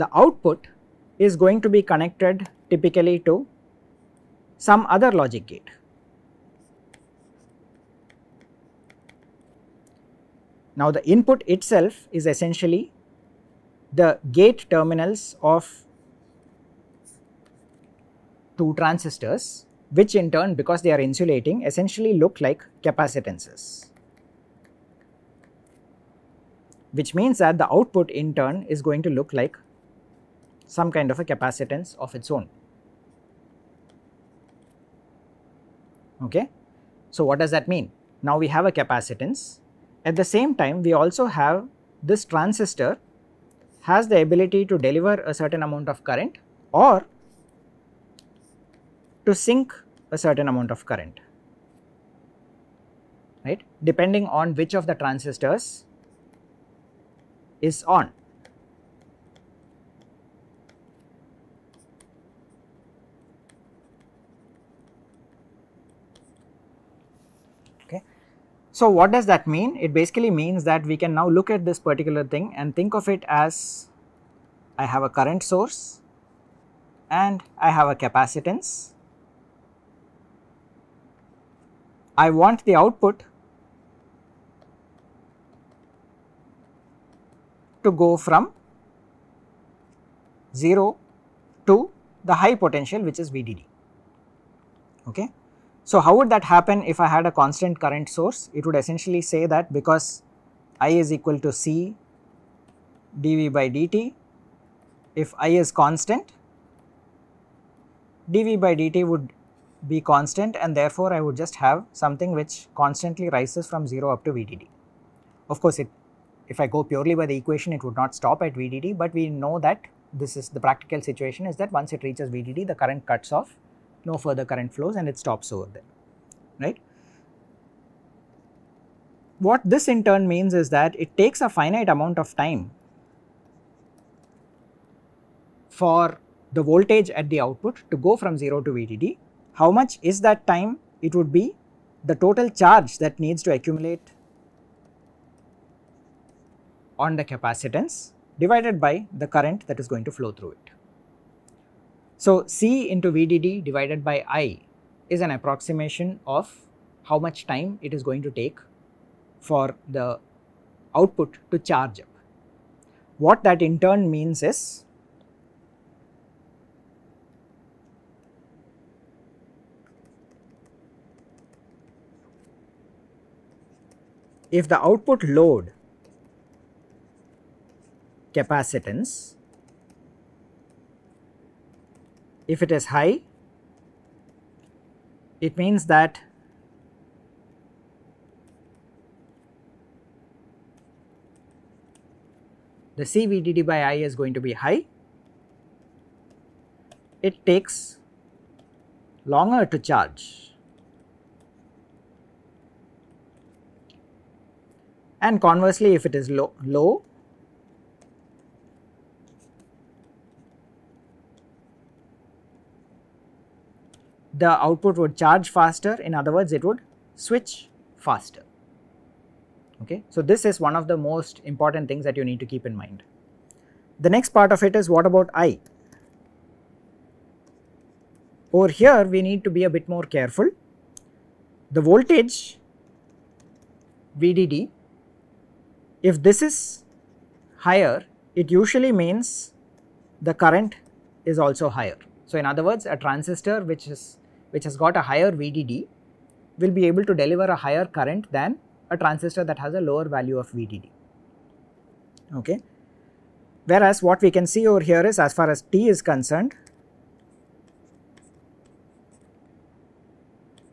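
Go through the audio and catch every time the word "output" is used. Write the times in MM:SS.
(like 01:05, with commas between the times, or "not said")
00:00, 00:27, 01:22, 02:17, 02:40, 02:54, 03:34.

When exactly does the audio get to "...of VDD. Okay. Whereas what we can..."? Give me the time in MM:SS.
04:10.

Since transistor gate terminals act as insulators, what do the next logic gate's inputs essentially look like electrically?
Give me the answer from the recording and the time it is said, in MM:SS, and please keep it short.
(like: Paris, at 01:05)
Capacitances, at 00:22.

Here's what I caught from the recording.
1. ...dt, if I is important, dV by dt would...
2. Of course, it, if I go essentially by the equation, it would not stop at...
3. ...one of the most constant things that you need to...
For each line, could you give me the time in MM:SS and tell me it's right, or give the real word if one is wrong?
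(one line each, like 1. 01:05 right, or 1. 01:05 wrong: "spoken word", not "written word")
1. 01:43 wrong: "constant", not "important"
2. 01:55 wrong: "purely", not "essentially"
3. 03:40 wrong: "important", not "constant".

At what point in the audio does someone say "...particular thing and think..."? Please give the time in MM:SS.
01:11.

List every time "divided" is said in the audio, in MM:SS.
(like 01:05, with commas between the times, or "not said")
02:28, 02:33.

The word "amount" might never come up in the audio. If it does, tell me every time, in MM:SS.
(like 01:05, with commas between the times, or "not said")
00:45, 00:50, 02:11.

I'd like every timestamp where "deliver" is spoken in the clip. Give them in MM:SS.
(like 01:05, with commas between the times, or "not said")
00:44, 04:07.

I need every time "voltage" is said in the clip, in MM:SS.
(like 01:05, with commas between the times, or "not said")
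02:16, 03:51.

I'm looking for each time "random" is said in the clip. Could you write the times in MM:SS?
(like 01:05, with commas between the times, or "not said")
not said.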